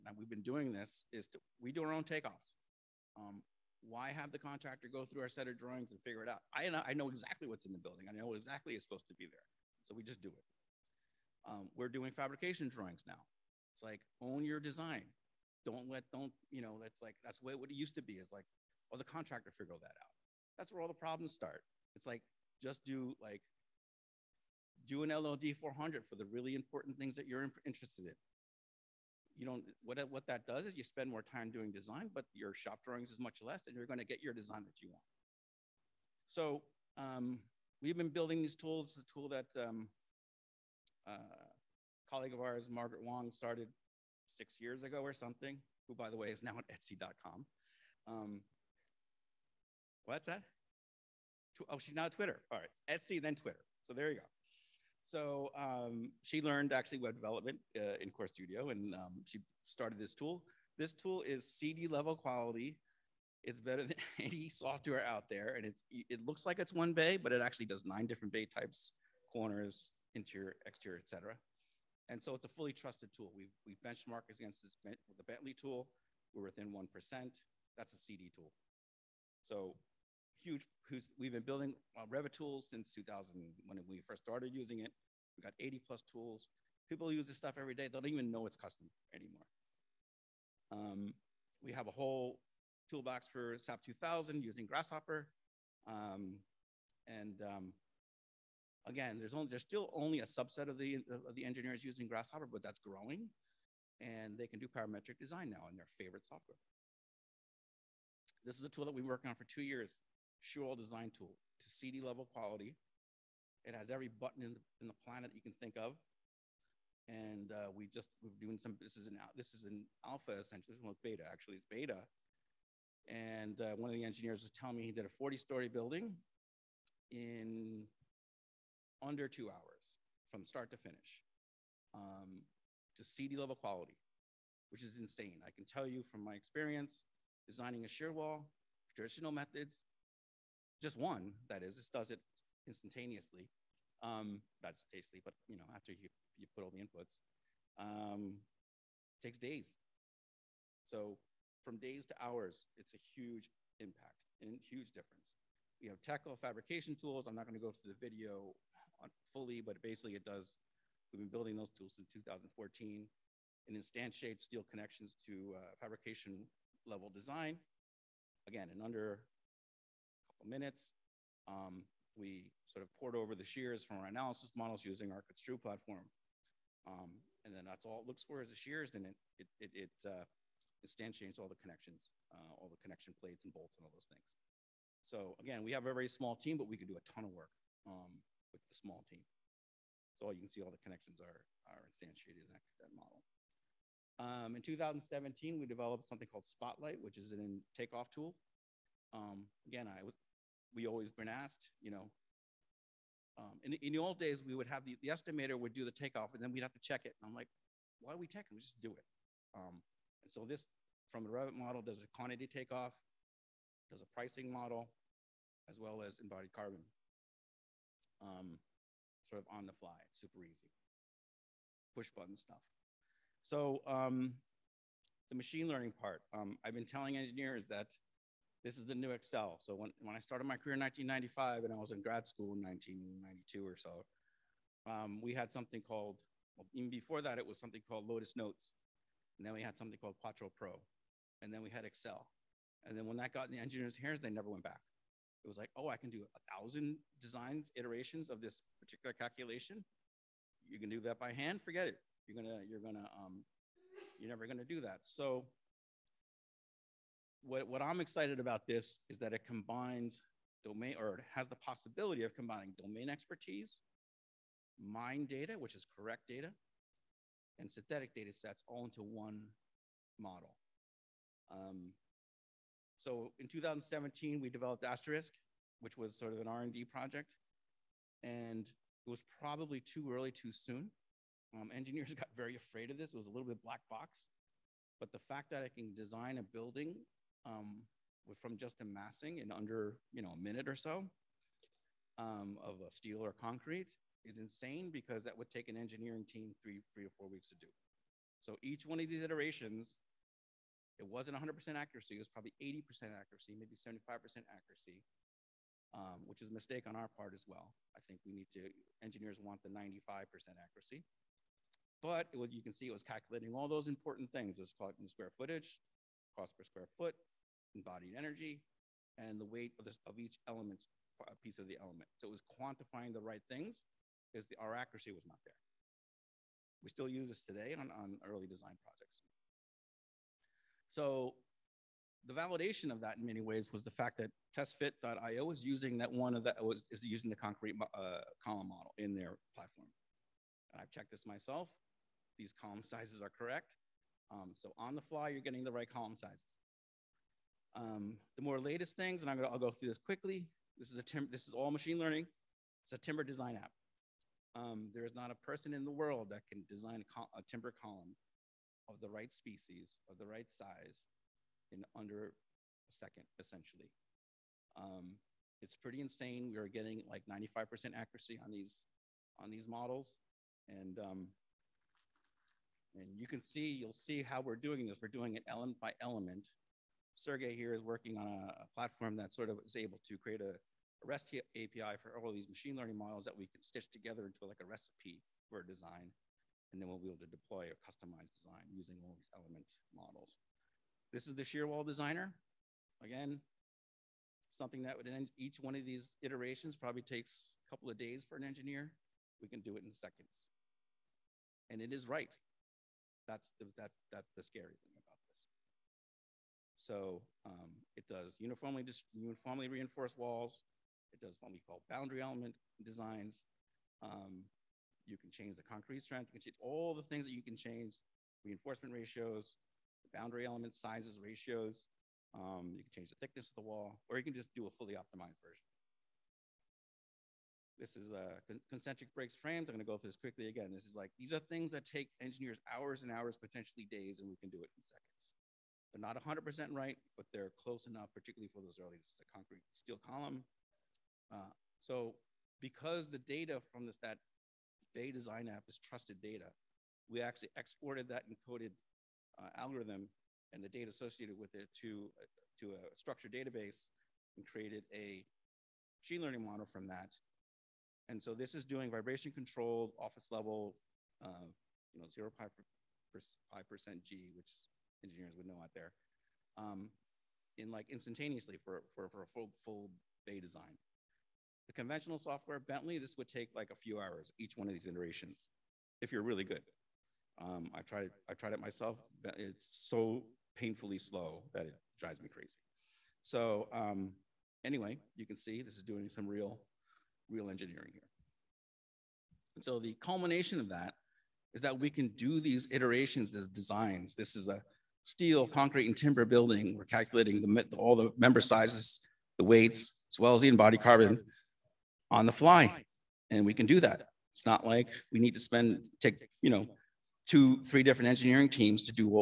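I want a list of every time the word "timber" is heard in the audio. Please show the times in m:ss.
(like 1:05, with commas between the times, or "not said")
5:52, 5:57, 8:15.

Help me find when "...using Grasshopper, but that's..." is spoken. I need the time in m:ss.
1:41.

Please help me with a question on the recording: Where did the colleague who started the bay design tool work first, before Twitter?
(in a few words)
Etsy.com.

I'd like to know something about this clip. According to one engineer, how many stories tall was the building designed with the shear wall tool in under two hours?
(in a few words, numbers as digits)
40 story.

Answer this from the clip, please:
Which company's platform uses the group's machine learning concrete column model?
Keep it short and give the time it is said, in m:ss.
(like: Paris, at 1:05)
testfit.io, at 5:34.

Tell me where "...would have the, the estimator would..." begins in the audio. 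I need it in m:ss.
3:24.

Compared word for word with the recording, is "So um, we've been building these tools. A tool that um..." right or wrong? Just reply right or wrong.
right.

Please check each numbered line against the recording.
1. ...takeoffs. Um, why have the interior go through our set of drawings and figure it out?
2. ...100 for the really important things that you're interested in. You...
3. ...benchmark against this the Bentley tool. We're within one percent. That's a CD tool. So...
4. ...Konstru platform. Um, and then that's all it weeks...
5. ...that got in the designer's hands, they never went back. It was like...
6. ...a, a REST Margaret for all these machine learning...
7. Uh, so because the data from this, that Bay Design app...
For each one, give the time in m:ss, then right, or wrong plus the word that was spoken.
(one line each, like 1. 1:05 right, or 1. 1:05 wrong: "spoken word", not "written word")
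1. 0:02 wrong: "contractor", not "interior"
2. 0:25 wrong: "400", not "100"
3. 1:13 right
4. 2:55 wrong: "looks", not "weeks"
5. 4:03 wrong: "engineer", not "designer"
6. 6:20 wrong: "API", not "Margaret"
7. 7:21 right.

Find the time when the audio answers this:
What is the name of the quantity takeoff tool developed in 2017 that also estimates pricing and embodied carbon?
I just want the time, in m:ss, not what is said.
3:16.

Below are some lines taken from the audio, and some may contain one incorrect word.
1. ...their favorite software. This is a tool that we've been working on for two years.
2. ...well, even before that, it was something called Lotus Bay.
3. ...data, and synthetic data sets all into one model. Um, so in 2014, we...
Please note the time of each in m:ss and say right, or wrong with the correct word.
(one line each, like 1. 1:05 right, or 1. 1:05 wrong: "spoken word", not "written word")
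1. 1:45 right
2. 3:56 wrong: "Notes", not "Bay"
3. 4:26 wrong: "2017", not "2014".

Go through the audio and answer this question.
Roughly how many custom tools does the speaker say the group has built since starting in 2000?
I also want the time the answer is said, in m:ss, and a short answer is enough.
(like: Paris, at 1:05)
80 plus, at 1:25.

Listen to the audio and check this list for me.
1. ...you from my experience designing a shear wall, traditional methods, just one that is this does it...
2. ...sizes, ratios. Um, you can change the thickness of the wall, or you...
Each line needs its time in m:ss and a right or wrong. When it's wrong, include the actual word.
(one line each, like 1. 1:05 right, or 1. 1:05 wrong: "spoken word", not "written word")
1. 2:15 right
2. 7:00 right.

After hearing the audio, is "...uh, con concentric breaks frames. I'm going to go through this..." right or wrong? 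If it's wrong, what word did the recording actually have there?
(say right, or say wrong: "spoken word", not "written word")
right.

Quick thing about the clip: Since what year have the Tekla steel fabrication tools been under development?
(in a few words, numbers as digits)
2014.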